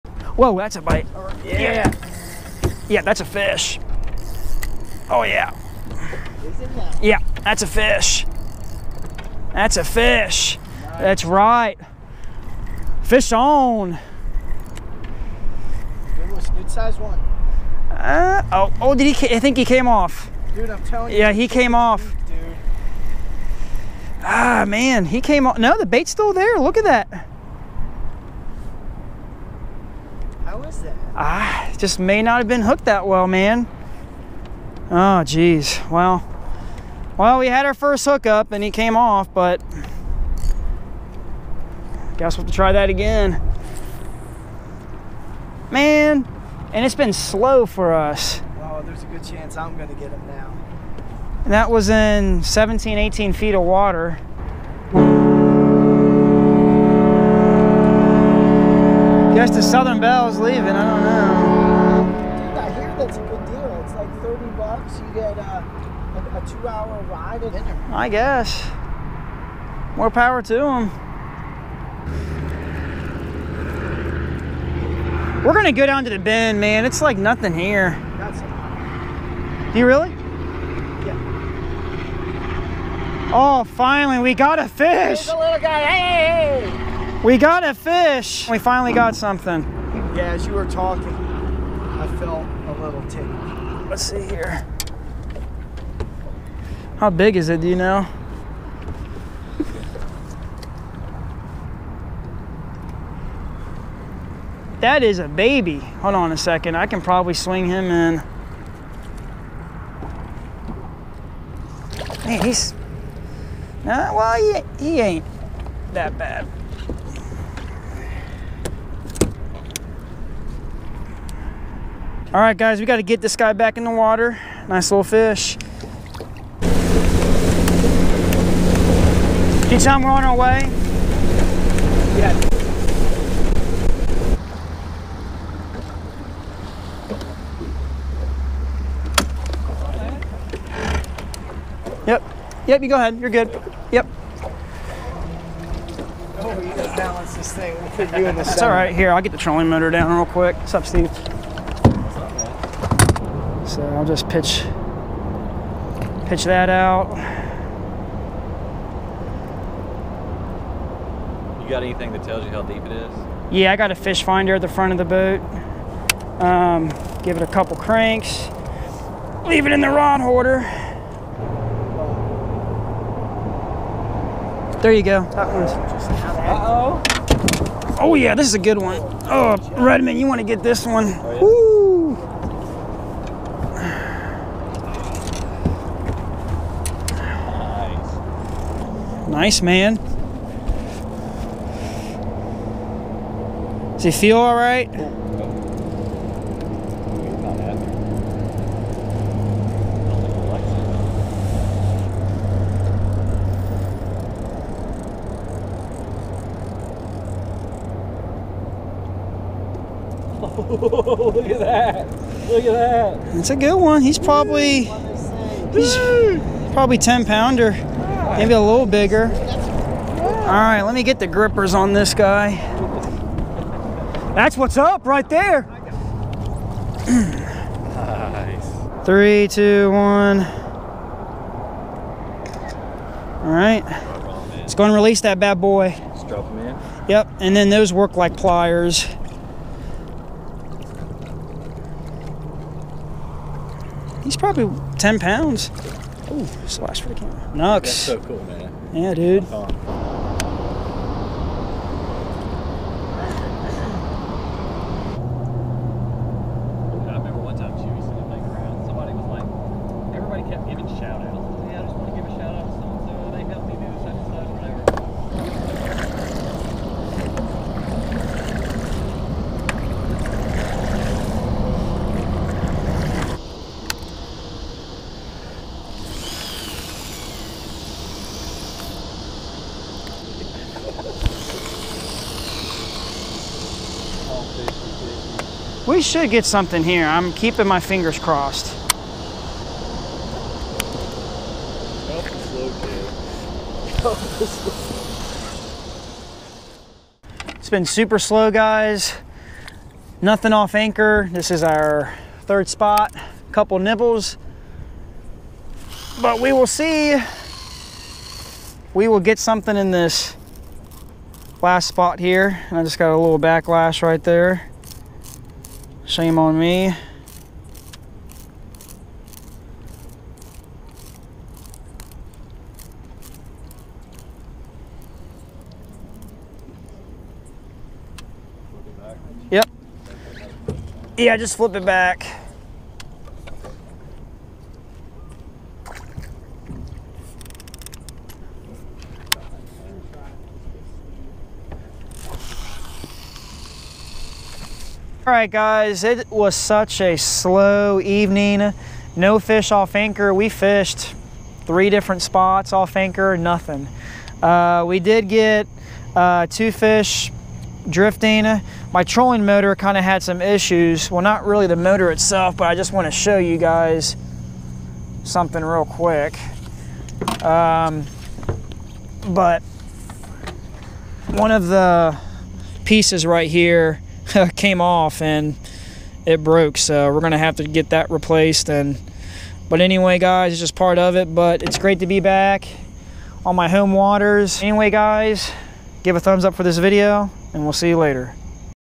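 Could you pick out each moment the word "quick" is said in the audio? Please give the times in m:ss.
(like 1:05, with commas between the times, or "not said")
2:30, 6:05.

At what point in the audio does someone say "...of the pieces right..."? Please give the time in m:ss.
6:11.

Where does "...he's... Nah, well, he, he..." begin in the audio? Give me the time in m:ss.
1:52.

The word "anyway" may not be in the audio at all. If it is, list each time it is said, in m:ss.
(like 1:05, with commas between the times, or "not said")
6:19, 6:24.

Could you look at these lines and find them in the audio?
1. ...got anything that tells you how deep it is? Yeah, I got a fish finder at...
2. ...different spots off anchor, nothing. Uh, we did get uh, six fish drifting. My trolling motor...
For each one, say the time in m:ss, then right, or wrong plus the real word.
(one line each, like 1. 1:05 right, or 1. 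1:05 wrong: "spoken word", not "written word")
1. 2:41 right
2. 5:51 wrong: "two", not "six".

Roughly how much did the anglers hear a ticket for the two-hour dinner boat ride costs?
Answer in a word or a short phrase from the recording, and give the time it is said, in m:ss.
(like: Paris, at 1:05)
30 bucks, at 1:04.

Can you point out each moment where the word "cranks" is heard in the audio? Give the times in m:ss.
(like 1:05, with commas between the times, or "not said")
2:47.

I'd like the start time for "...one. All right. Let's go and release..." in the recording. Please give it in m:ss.
3:49.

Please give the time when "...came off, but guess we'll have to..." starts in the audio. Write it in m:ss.
0:38.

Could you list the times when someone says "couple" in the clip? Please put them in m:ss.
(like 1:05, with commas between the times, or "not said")
2:47, 5:03.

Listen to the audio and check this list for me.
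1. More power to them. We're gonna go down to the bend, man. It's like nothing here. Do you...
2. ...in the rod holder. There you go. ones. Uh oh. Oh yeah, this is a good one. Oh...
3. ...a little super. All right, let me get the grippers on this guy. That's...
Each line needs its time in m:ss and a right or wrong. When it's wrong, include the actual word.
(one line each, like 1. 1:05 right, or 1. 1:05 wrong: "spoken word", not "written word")
1. 1:09 right
2. 2:49 right
3. 3:38 wrong: "bigger", not "super".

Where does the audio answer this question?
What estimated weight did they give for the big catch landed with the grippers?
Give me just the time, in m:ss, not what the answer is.
4:04.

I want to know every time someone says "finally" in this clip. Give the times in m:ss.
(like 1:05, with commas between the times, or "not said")
1:23, 1:28.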